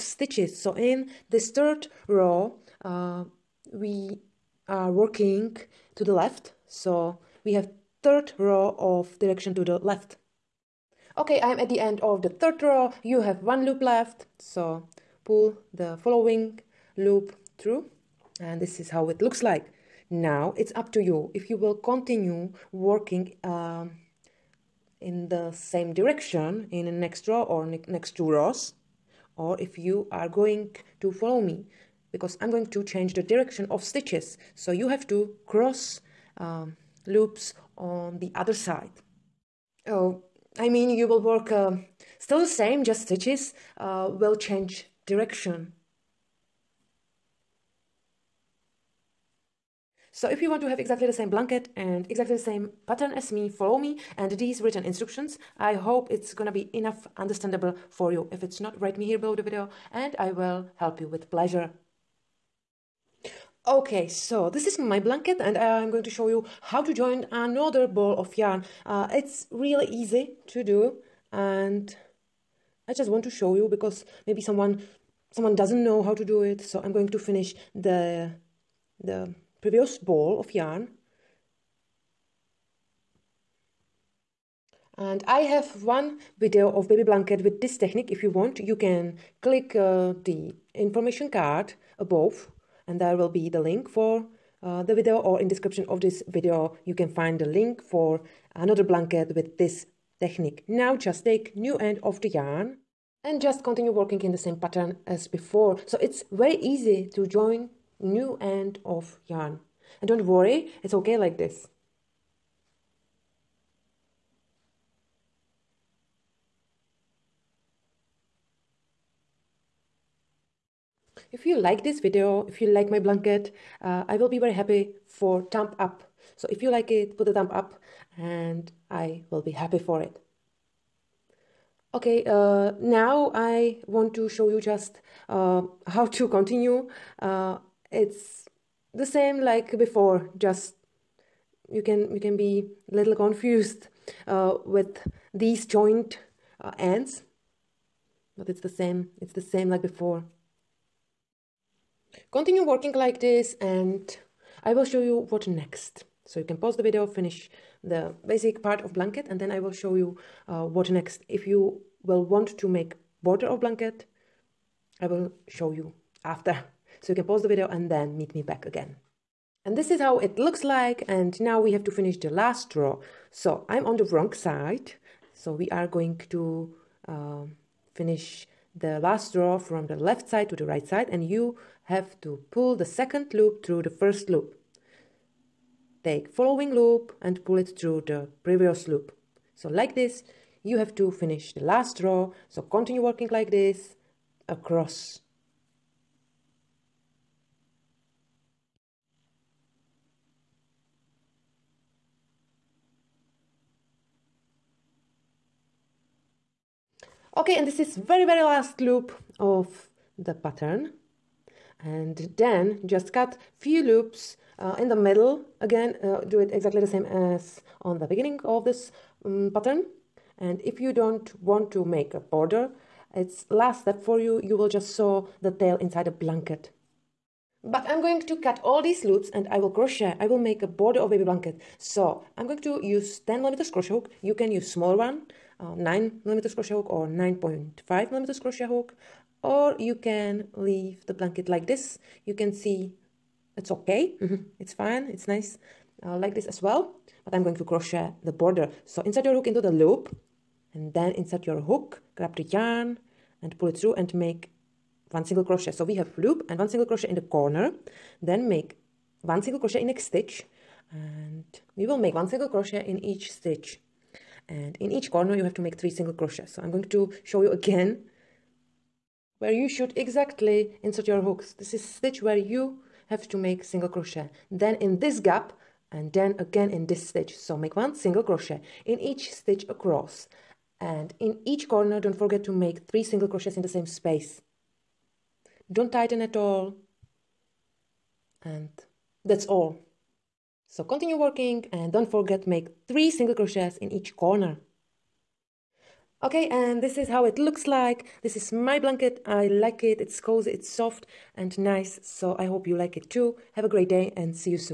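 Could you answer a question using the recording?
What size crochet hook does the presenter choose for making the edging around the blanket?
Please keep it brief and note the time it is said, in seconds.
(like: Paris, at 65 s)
10 millimeters, at 233 s.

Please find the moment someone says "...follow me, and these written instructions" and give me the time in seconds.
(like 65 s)
53 s.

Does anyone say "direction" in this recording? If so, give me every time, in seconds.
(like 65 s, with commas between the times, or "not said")
9 s, 25 s, 33 s, 45 s.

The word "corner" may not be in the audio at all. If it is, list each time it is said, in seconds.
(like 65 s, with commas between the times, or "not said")
257 s, 265 s, 281 s, 294 s.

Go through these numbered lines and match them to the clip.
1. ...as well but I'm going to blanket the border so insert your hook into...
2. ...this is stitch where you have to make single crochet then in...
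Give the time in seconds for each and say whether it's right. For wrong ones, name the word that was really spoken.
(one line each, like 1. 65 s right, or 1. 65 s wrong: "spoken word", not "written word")
1. 246 s wrong: "crochet", not "blanket"
2. 271 s right.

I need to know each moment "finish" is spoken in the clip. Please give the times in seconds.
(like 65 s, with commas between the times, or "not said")
77 s, 157 s, 171 s, 177 s, 191 s.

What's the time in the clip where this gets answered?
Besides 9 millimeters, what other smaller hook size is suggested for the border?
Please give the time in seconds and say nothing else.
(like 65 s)
237 s.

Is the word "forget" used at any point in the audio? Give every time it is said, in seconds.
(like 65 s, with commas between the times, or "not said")
282 s, 292 s.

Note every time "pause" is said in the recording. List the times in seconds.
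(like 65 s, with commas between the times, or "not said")
156 s, 167 s.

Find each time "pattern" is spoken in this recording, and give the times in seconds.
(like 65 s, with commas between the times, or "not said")
52 s, 104 s, 210 s, 219 s.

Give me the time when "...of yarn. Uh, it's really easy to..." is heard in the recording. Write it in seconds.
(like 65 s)
68 s.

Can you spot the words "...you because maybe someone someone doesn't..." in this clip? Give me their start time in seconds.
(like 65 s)
73 s.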